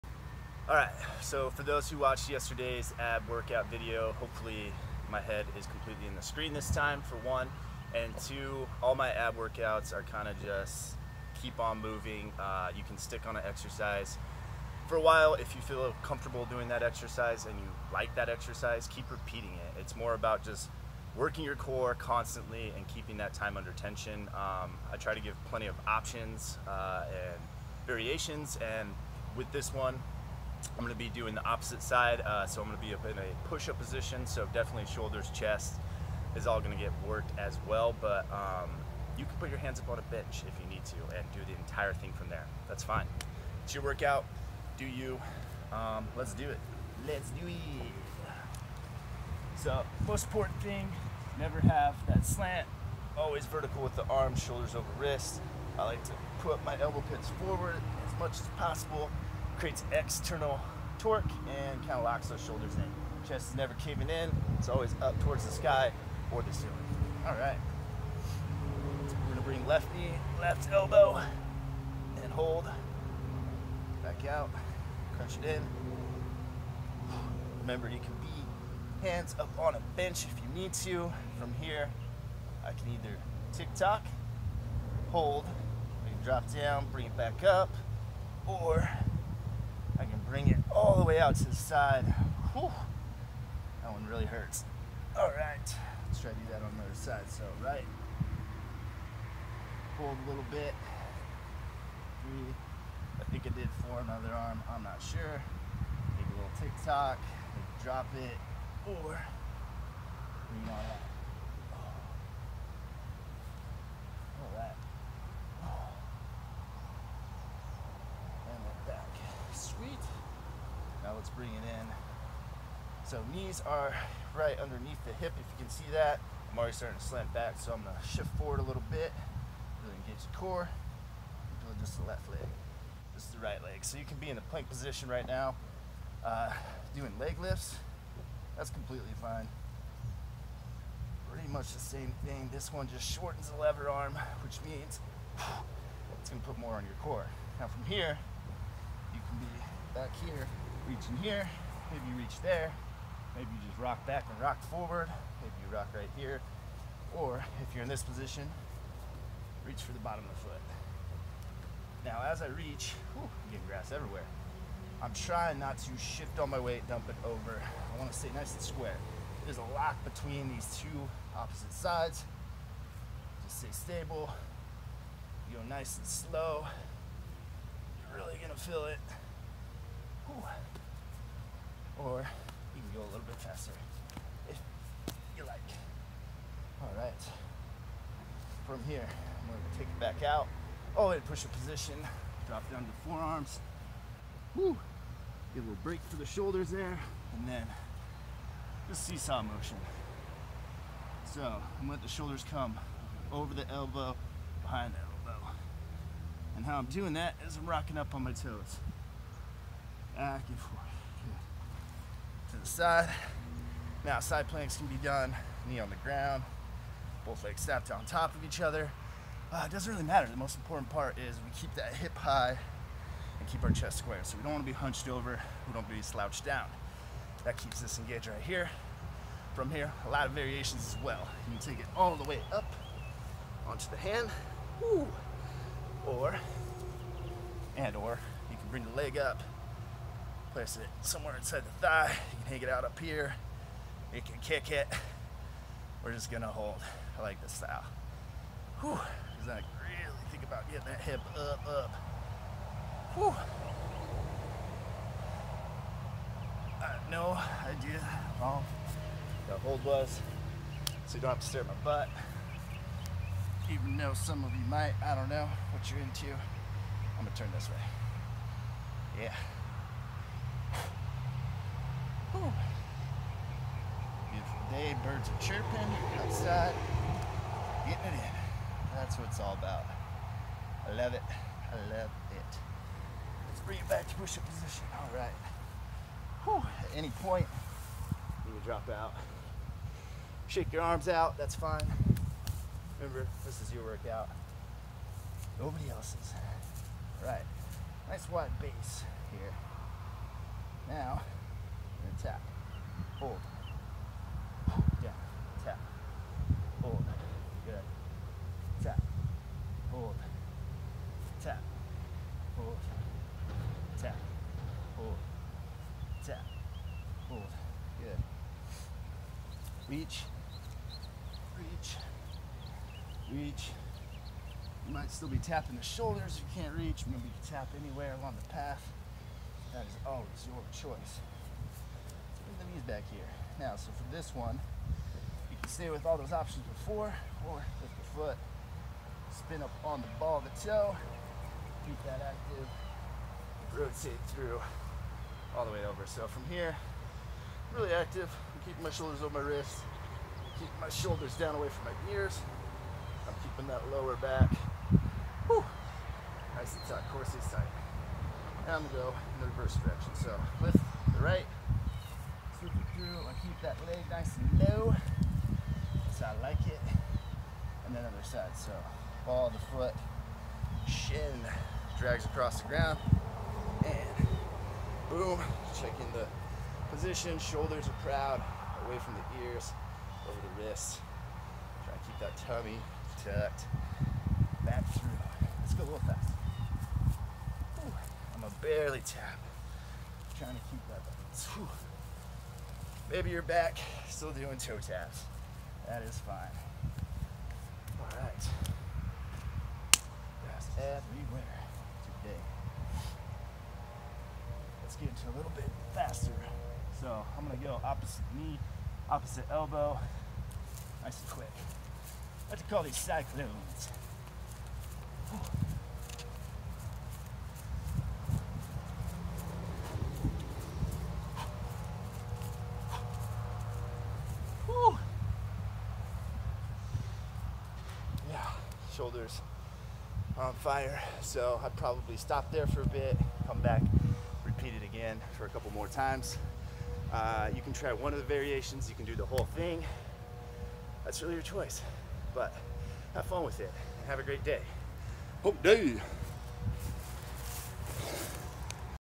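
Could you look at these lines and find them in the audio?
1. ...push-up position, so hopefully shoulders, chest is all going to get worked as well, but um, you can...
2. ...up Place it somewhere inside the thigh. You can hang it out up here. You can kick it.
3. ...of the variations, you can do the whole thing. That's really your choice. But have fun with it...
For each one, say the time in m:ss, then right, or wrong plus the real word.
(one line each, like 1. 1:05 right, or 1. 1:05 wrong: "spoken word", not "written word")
1. 0:33 wrong: "definitely", not "hopefully"
2. 3:59 right
3. 7:18 right.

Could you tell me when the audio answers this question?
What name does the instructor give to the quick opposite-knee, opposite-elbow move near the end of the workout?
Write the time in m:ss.
6:52.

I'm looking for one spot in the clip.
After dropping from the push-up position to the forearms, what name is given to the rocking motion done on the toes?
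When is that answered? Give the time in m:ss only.
3:18.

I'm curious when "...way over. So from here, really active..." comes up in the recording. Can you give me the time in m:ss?
5:45.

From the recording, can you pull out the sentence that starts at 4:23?
Even though some of you might, I don't know what you're into.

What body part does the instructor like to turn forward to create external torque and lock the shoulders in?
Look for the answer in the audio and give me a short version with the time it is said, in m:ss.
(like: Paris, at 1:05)
Elbow pits, at 0:56.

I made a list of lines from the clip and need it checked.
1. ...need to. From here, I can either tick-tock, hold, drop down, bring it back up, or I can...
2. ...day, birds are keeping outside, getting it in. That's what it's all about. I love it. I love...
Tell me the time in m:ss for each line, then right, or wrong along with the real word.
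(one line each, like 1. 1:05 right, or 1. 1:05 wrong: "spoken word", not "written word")
1. 1:20 right
2. 4:34 wrong: "chirping", not "keeping".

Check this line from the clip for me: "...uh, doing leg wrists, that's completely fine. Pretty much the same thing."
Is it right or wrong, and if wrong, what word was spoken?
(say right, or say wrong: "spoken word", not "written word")
wrong: "lifts", not "wrists".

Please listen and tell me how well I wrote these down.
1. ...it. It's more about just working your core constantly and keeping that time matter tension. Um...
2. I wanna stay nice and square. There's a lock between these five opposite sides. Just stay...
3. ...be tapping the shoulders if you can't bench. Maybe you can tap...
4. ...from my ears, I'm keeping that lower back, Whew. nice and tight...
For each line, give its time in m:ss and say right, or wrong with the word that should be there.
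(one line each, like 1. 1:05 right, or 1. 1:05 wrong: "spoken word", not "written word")
1. 0:19 wrong: "under", not "matter"
2. 2:47 wrong: "two", not "five"
3. 5:25 wrong: "reach", not "bench"
4. 5:51 right.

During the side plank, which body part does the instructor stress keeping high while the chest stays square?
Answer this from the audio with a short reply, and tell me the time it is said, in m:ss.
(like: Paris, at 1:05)
The hip, at 3:41.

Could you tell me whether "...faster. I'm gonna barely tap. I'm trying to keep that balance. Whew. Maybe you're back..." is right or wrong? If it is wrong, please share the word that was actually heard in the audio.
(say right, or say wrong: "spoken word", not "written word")
right.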